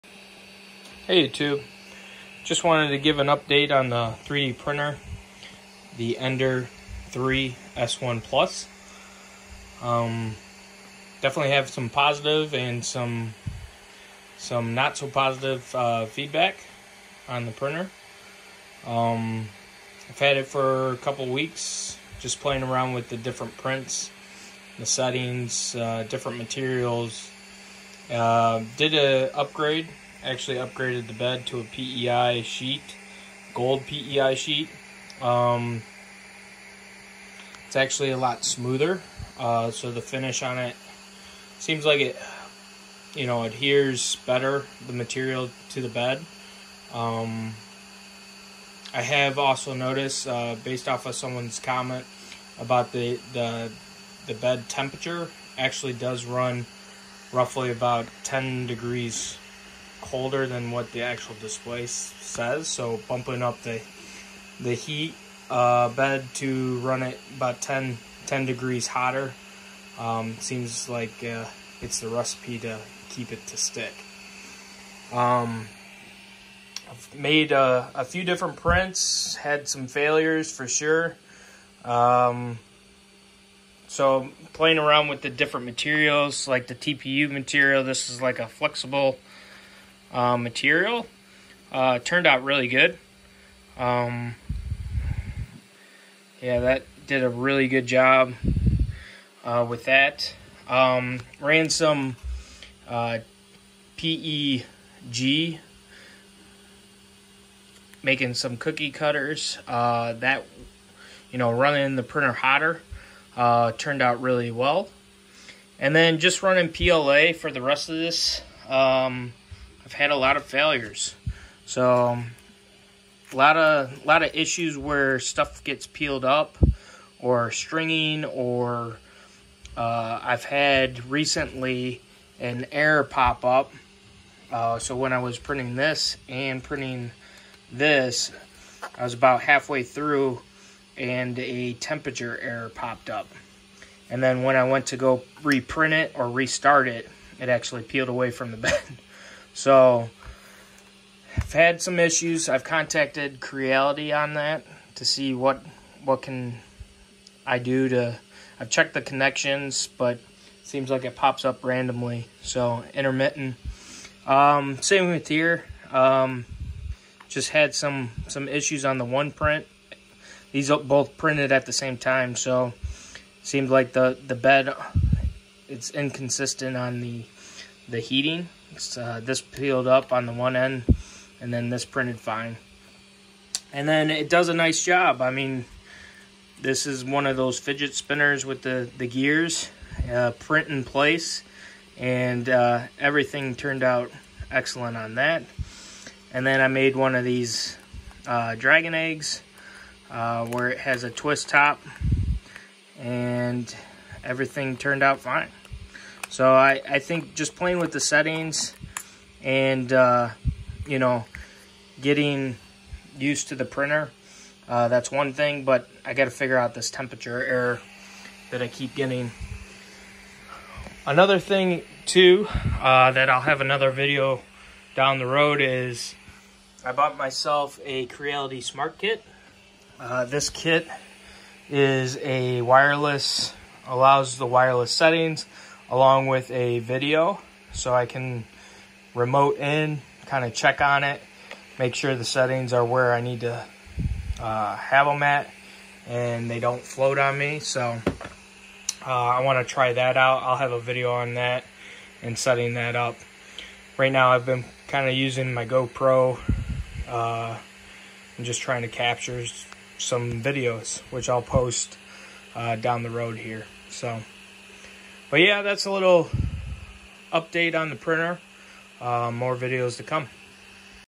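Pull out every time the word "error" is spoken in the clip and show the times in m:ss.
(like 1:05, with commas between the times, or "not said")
2:12, 2:22, 3:37.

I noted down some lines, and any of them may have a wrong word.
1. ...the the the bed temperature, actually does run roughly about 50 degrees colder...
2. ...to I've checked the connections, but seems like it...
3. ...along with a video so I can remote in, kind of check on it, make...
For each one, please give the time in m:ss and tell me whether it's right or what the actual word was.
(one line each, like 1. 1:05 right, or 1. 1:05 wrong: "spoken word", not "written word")
1. 0:52 wrong: "10", not "50"
2. 2:37 right
3. 3:55 right.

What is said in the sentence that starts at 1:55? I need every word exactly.
And then just running PLA for the rest of this.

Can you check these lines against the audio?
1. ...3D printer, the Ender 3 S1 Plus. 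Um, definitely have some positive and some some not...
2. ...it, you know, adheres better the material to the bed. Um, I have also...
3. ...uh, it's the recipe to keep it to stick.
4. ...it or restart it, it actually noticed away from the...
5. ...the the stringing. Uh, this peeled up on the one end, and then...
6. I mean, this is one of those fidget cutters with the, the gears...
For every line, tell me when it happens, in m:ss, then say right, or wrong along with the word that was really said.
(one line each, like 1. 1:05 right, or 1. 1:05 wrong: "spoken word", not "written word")
1. 0:04 right
2. 0:42 right
3. 1:11 right
4. 2:25 wrong: "peeled", not "noticed"
5. 2:56 wrong: "heating", not "stringing"
6. 3:05 wrong: "spinners", not "cutters".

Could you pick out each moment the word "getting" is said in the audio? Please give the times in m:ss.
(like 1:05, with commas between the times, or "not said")
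3:31, 3:38.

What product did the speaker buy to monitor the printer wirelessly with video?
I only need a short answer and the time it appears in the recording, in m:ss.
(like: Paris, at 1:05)
Creality Smart Kit, at 3:48.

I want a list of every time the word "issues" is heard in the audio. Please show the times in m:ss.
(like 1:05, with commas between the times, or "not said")
2:04, 2:31, 2:48.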